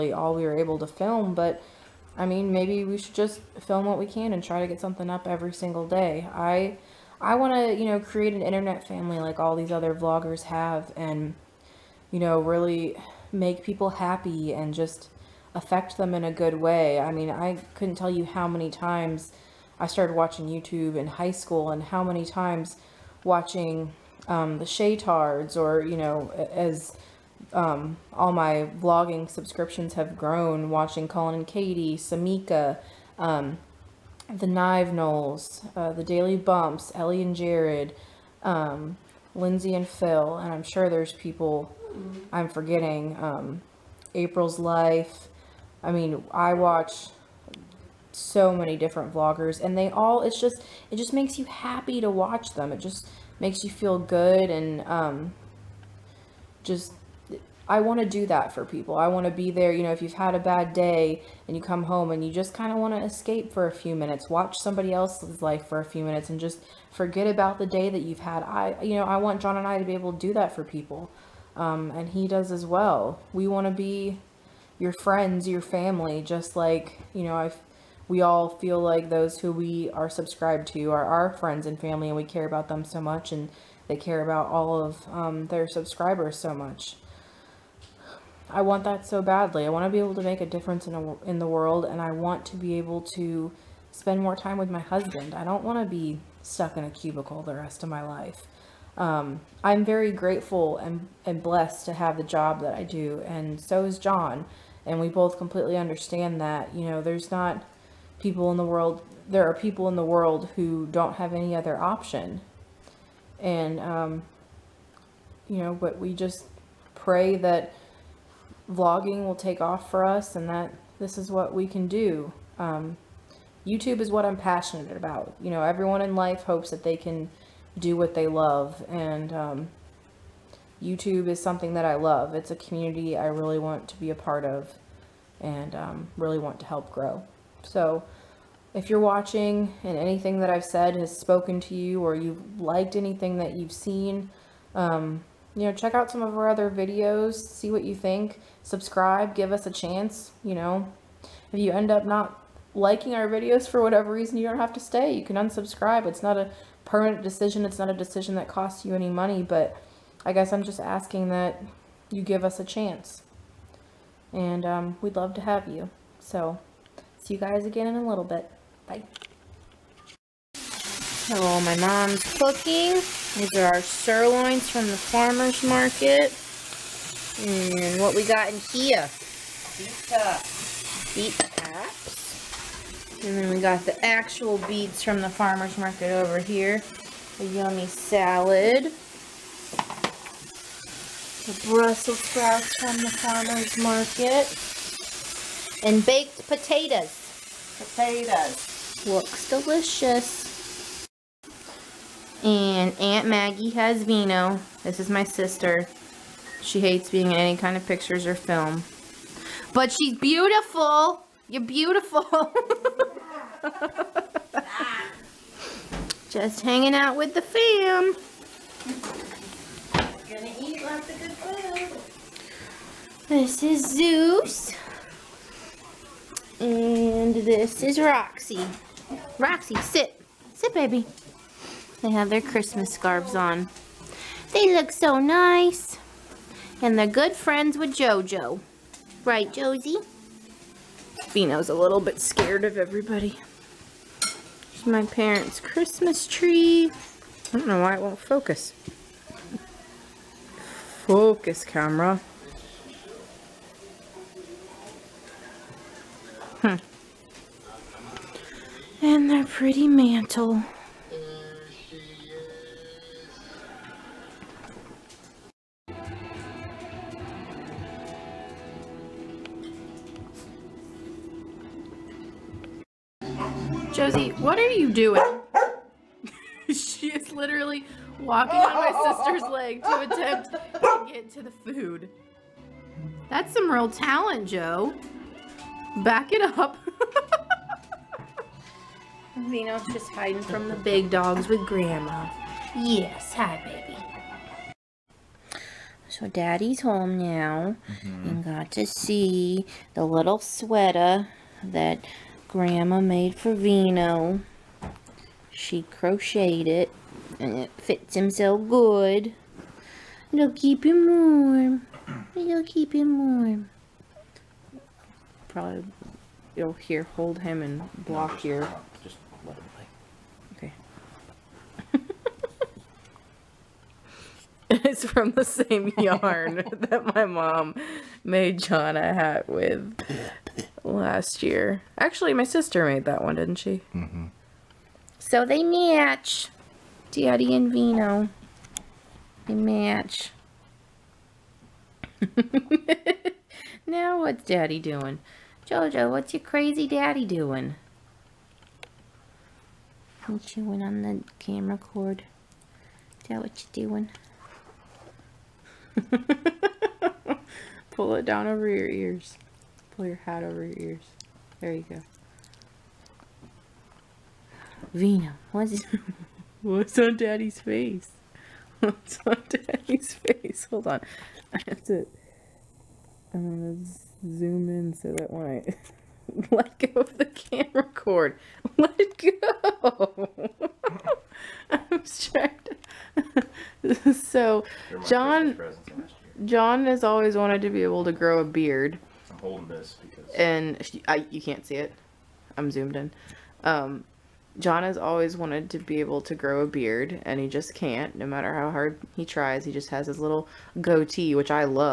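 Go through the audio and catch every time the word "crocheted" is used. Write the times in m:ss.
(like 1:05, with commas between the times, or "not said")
5:05.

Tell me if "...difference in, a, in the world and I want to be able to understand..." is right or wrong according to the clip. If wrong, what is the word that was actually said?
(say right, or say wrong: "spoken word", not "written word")
wrong: "spend", not "understand".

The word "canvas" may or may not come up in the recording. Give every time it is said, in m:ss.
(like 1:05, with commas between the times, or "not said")
not said.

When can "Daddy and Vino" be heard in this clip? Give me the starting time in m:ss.
5:37.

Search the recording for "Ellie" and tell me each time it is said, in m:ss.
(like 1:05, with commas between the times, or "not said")
0:36.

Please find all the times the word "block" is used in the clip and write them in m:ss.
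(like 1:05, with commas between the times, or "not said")
5:18.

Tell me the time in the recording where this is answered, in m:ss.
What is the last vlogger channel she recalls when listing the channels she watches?
0:44.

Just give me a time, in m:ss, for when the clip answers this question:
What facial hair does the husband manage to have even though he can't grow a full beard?
6:40.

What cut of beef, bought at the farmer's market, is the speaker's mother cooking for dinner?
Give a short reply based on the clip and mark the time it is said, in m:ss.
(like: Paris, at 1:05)
sirloins, at 2:53.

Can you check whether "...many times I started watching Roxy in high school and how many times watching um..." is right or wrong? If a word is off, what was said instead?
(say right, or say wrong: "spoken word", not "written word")
wrong: "YouTube", not "Roxy".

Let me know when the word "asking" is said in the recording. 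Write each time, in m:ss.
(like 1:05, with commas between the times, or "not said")
2:40.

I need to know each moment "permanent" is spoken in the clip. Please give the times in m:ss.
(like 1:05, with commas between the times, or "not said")
2:36.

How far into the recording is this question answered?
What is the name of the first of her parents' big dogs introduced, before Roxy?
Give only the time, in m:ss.
3:43.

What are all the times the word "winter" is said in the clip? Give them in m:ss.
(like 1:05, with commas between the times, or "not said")
not said.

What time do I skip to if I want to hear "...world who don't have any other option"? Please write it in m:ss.
1:50.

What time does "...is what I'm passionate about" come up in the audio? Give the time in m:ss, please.
2:03.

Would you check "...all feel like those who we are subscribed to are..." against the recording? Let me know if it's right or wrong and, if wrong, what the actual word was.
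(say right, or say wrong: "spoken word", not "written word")
right.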